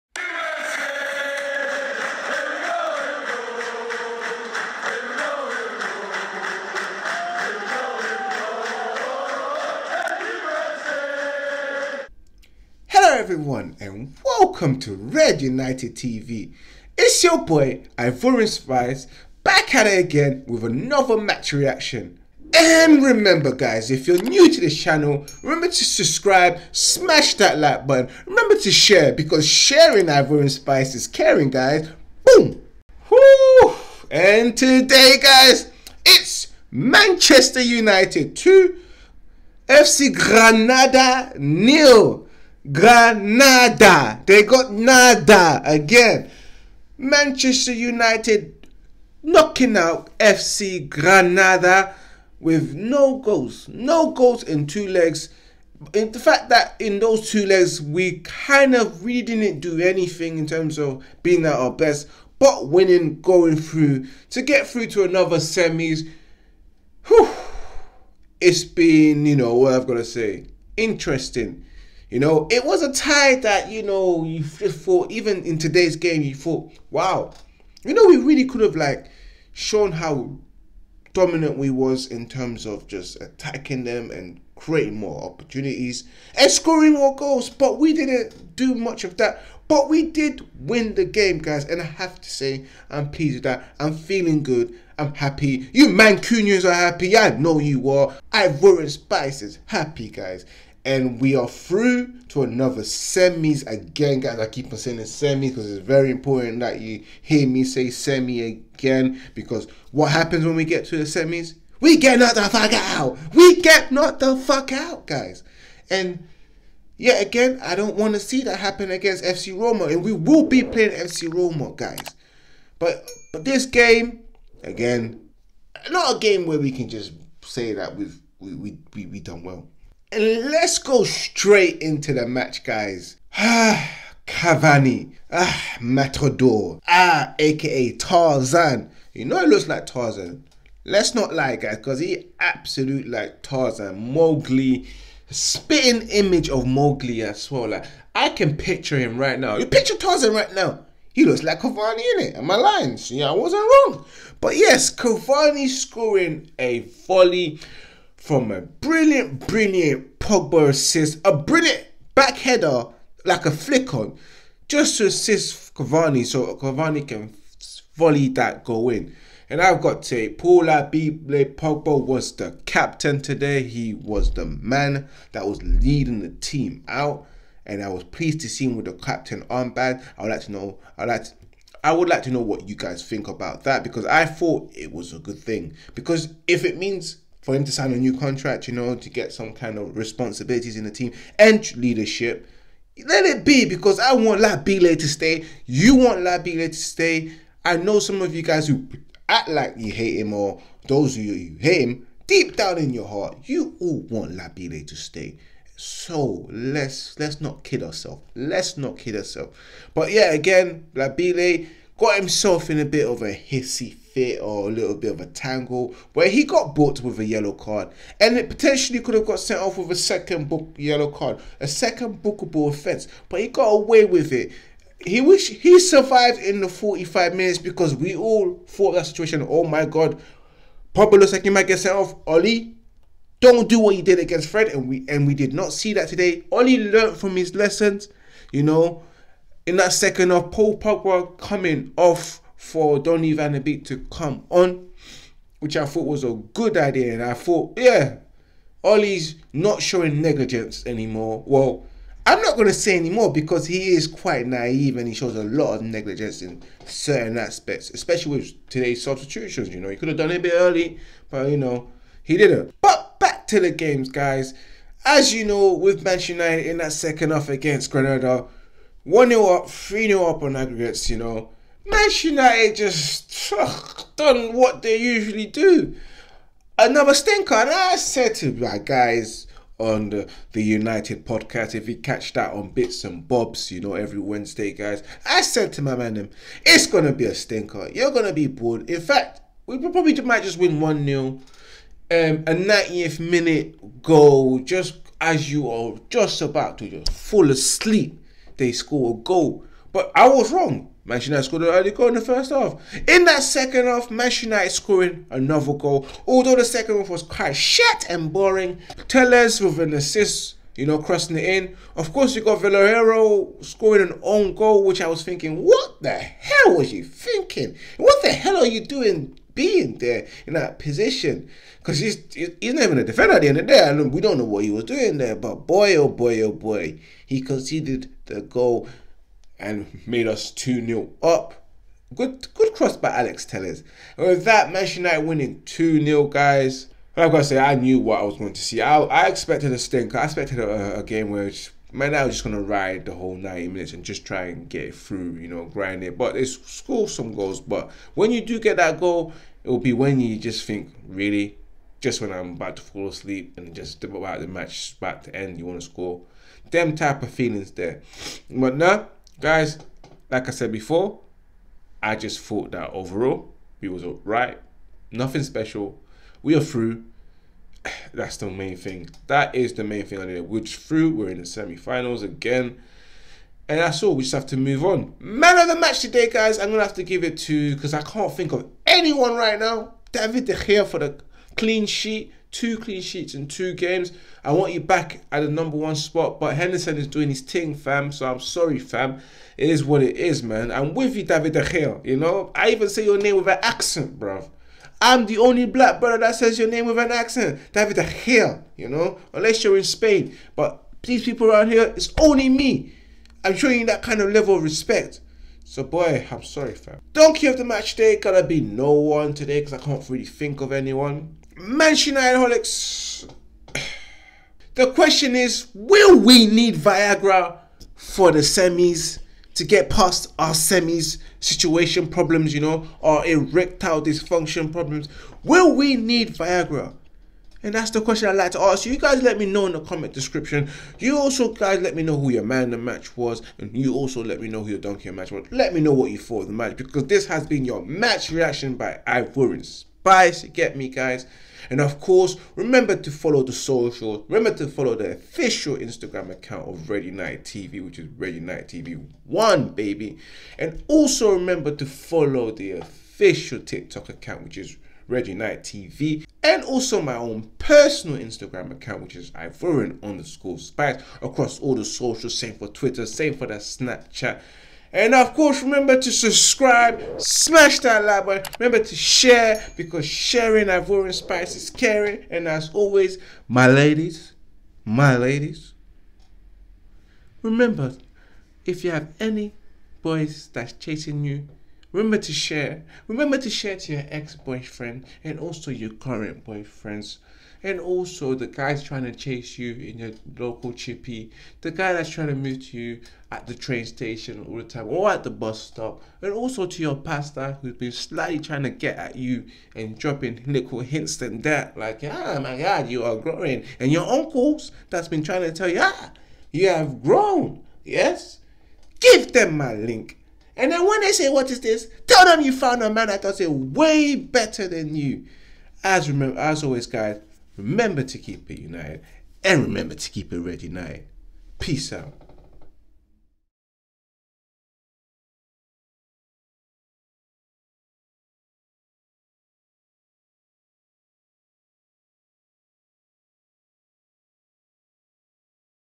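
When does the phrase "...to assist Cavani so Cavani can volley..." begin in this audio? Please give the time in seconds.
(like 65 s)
164 s.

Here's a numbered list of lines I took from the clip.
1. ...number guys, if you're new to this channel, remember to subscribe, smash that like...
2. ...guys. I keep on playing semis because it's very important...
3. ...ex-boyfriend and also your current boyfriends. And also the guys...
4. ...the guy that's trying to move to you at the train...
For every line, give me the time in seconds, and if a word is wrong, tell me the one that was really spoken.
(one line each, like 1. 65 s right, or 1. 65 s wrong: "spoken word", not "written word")
1. 23 s wrong: "remember", not "number"
2. 104 s wrong: "saying", not "playing"
3. 484 s right
4. 491 s right.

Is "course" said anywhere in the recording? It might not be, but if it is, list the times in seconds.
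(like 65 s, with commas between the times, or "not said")
312 s, 441 s, 465 s.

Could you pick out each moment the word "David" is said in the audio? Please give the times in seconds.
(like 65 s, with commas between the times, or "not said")
380 s, 391 s, 397 s.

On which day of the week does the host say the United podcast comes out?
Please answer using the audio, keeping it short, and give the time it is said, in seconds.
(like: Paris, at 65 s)
Wednesday, at 283 s.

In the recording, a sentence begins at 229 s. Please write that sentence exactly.
Oh my god, Pablo looks like he might get sent off.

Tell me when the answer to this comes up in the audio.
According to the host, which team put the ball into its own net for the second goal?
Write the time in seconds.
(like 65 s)
312 s.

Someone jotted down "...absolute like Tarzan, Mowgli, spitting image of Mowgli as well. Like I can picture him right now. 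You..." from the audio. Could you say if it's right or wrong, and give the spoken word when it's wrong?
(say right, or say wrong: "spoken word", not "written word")
right.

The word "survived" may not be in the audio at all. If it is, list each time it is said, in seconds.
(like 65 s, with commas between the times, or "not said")
225 s.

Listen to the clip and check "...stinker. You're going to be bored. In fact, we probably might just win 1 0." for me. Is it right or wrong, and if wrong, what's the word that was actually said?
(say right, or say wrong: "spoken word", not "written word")
right.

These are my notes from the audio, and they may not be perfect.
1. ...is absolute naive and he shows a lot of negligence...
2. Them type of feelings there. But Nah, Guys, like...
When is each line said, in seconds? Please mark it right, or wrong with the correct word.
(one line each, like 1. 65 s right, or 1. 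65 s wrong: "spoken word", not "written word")
1. 253 s wrong: "quite", not "absolute"
2. 356 s right.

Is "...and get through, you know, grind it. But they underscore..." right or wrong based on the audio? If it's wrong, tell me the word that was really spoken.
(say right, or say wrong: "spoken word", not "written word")
wrong: "score", not "underscore".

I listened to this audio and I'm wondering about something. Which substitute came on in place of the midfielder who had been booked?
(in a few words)
Donny van de Beek.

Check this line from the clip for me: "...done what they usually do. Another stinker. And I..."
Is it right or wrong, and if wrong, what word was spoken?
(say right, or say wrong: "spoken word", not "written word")
right.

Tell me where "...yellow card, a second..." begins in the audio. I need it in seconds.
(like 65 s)
220 s.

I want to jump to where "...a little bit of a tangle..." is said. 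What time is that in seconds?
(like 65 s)
214 s.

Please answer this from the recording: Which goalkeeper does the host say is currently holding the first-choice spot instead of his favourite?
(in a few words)
Henderson.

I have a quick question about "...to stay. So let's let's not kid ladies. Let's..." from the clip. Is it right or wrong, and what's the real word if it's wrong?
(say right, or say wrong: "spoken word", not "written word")
wrong: "ourselves", not "ladies".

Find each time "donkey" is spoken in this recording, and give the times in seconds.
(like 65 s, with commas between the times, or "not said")
407 s, 434 s.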